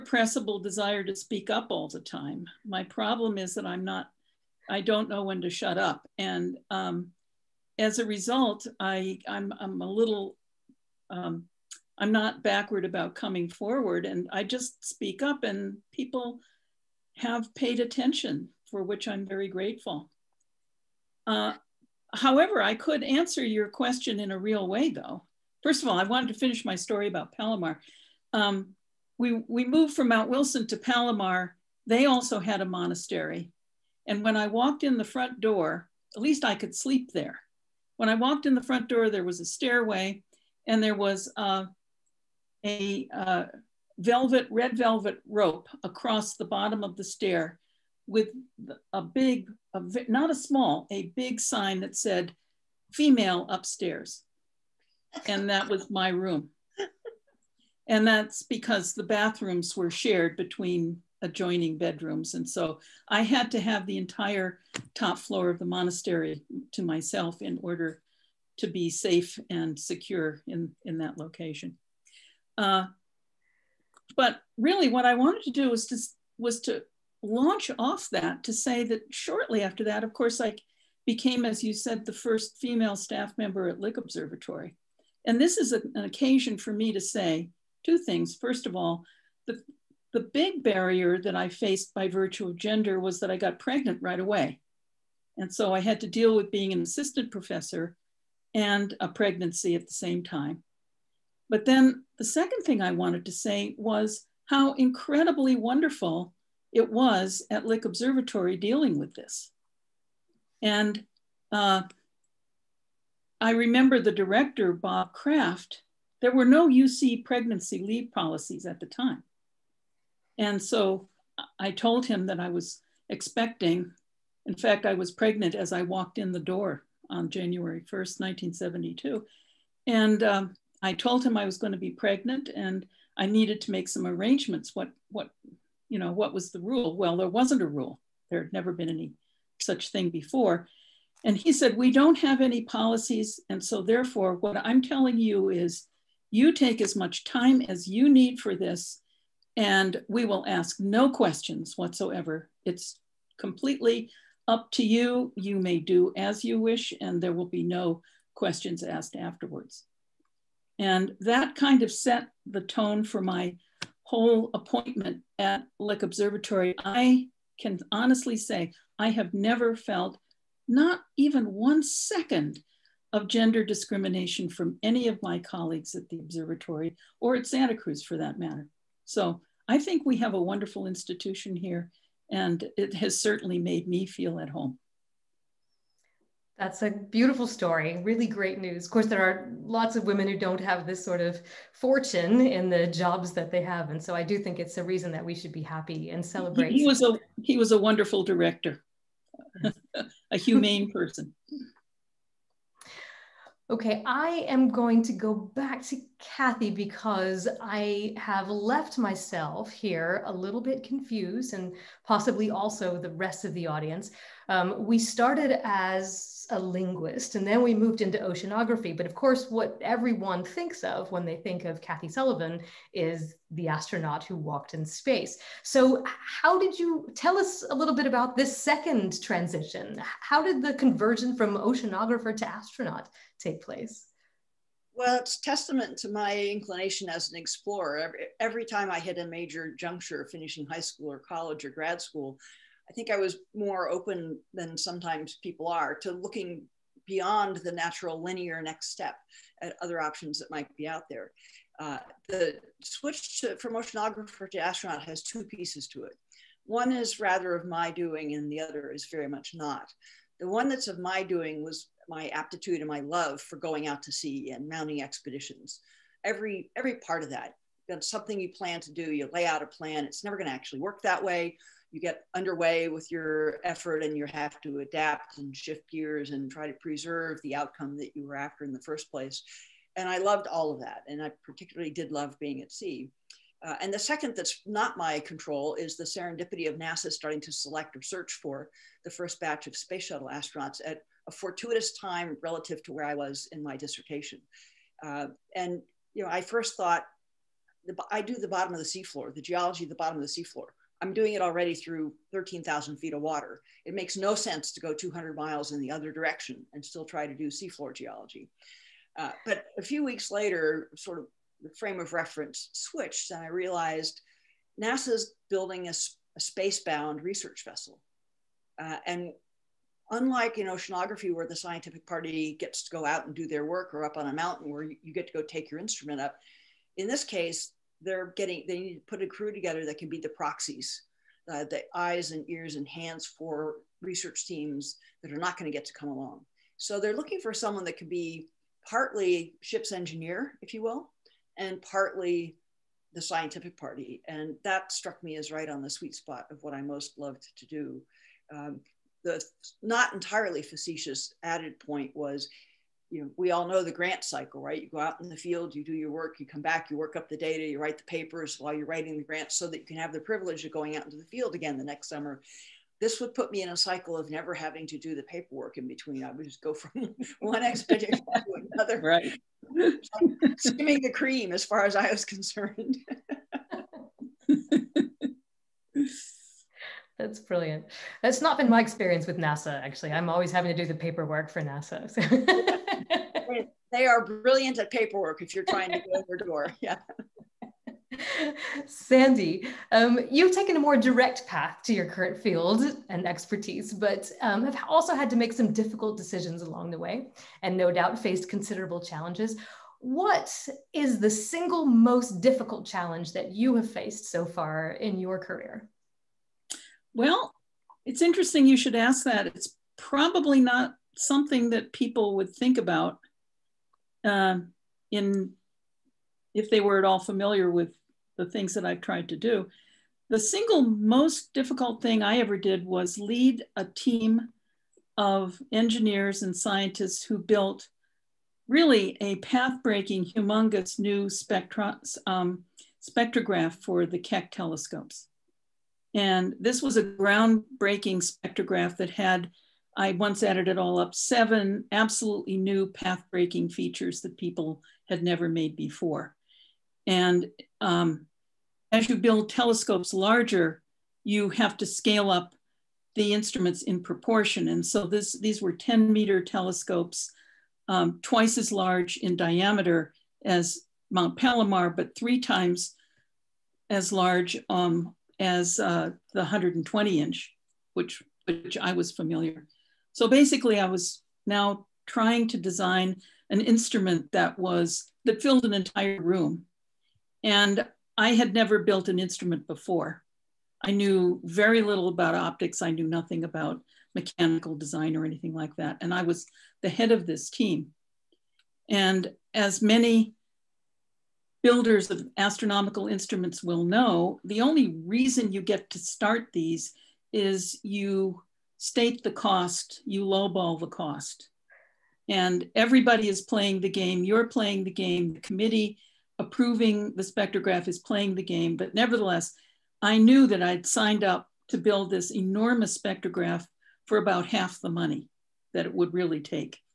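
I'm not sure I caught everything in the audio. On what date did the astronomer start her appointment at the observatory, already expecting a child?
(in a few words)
January 1st, 1972.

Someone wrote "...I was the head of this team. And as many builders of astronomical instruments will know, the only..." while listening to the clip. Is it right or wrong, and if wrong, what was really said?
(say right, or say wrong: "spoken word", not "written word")
right.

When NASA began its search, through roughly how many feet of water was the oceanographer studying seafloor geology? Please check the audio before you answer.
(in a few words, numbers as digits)
13,000.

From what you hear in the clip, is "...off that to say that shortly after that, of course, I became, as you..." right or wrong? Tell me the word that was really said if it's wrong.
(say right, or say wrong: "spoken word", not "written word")
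right.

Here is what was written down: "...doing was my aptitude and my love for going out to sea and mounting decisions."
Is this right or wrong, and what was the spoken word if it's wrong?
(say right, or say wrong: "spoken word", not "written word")
wrong: "expeditions", not "decisions".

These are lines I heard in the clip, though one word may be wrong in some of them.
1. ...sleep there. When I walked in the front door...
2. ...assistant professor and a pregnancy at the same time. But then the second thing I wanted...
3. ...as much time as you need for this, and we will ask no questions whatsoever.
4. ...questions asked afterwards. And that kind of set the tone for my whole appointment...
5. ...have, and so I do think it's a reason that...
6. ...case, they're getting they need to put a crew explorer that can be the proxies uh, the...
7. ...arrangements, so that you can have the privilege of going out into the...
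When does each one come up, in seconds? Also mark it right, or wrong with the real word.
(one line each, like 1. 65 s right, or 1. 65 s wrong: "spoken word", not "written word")
1. 36 s right
2. 96 s right
3. 146 s right
4. 158 s right
5. 193 s right
6. 327 s wrong: "together", not "explorer"
7. 359 s wrong: "grants", not "arrangements".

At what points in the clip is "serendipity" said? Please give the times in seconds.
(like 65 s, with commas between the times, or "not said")
286 s.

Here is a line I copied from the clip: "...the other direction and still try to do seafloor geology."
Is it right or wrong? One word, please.
right.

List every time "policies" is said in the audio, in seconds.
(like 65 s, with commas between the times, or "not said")
118 s, 142 s.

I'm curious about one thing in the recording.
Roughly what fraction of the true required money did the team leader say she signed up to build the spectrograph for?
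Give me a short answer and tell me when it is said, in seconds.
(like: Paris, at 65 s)
half, at 514 s.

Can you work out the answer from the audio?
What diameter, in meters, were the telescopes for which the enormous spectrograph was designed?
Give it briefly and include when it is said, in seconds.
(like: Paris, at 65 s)
10, at 455 s.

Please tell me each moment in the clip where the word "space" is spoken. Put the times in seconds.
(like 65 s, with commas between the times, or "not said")
224 s, 289 s, 316 s.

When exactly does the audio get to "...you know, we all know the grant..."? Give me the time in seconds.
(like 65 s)
353 s.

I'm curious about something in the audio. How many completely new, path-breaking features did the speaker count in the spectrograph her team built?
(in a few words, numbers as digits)
7.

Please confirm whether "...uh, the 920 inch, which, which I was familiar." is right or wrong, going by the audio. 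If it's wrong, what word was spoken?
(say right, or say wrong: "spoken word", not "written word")
wrong: "120", not "920".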